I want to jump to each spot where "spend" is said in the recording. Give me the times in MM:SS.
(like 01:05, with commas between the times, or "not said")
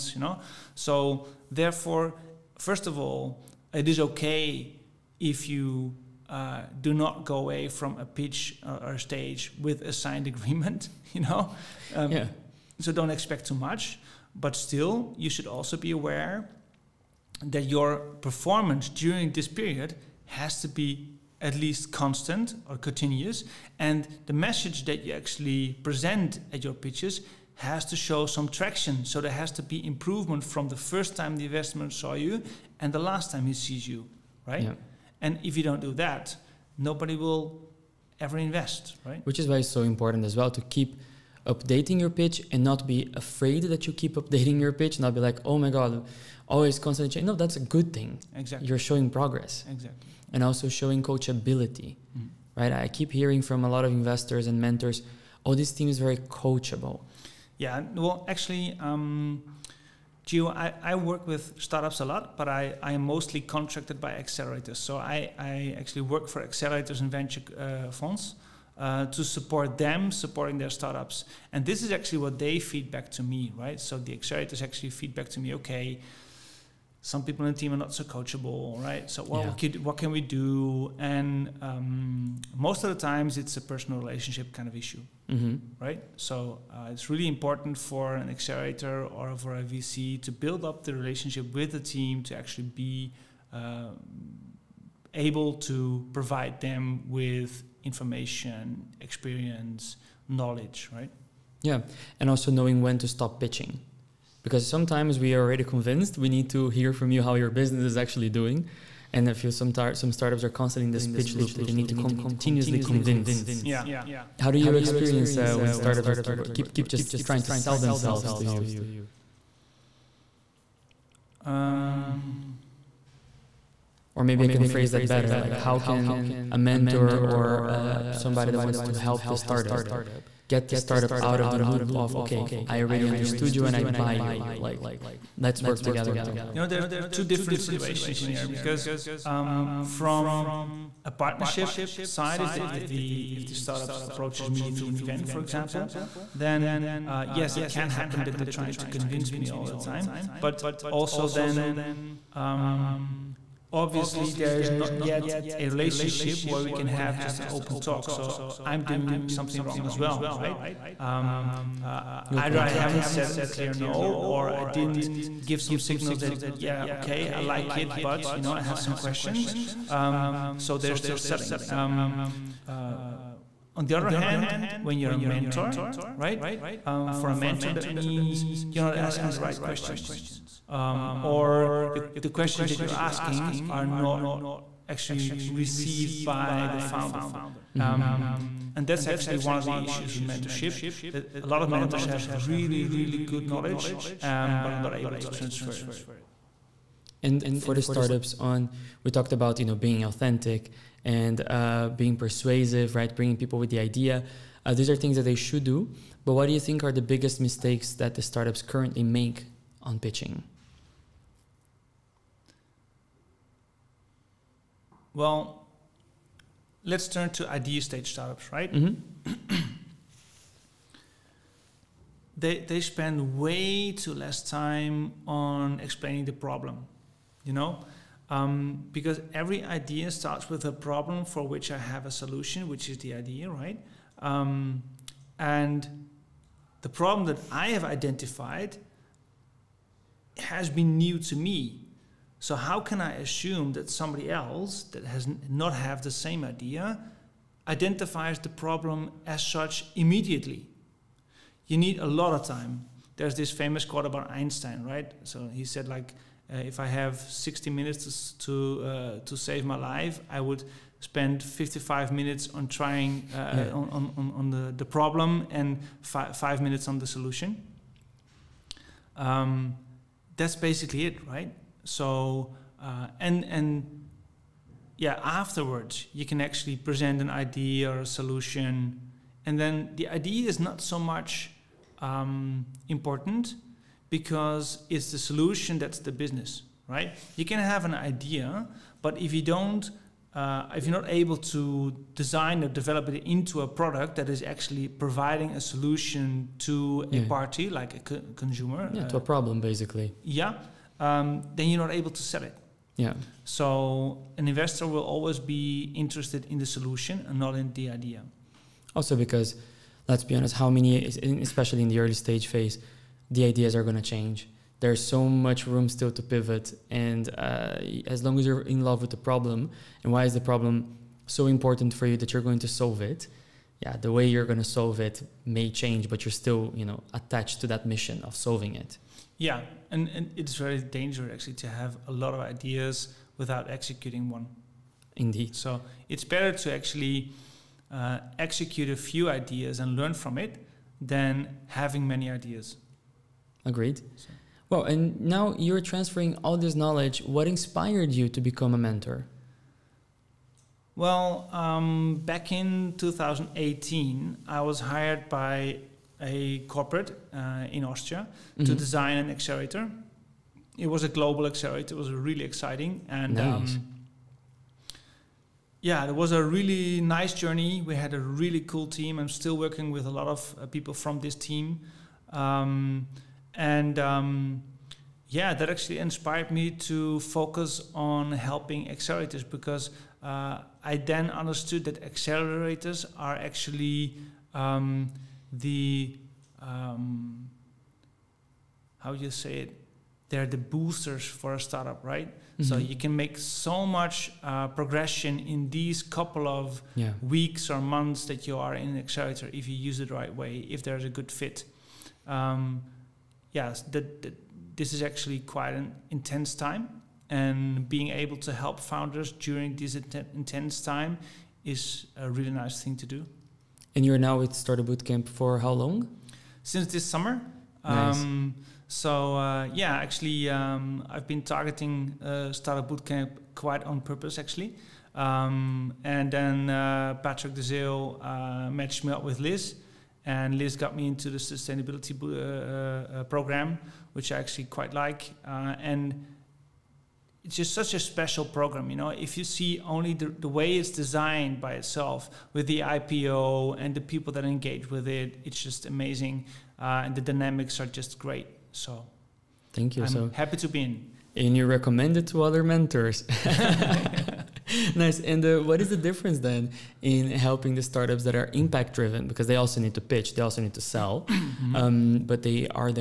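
03:42, 04:20.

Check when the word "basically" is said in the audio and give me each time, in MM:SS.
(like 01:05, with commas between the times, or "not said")
04:30, 04:59.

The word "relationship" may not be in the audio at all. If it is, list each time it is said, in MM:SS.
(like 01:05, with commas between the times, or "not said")
01:24, 01:30, 02:35.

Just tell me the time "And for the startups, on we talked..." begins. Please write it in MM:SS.
03:17.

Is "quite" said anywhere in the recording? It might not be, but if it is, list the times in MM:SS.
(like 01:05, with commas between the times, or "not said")
06:45, 07:03, 07:14.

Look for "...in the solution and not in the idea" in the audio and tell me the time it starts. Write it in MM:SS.
05:06.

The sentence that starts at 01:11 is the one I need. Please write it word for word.
And this is actually what they feedback to me, right?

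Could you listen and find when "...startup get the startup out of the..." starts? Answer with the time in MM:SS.
02:09.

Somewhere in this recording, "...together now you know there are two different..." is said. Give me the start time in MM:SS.
02:15.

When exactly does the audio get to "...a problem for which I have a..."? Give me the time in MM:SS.
03:50.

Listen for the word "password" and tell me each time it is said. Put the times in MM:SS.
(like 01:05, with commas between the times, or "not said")
not said.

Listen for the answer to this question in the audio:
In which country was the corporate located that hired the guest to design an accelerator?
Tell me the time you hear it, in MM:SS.
05:57.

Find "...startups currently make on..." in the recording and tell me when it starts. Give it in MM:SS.
03:28.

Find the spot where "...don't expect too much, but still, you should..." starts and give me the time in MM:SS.
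00:12.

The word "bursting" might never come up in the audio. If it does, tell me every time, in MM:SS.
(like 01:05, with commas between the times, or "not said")
not said.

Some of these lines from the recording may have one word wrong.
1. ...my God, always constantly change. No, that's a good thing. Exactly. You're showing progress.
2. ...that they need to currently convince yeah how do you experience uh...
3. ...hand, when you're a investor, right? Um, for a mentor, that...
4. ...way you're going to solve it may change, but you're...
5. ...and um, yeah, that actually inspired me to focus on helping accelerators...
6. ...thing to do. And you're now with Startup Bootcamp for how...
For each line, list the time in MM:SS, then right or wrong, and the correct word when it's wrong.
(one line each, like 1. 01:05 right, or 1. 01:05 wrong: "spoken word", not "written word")
1. 00:45 right
2. 01:51 wrong: "continuously", not "currently"
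3. 02:54 wrong: "mentor", not "investor"
4. 05:24 right
5. 06:13 right
6. 06:52 right.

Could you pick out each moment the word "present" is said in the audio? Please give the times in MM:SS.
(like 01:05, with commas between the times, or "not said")
00:25, 04:36.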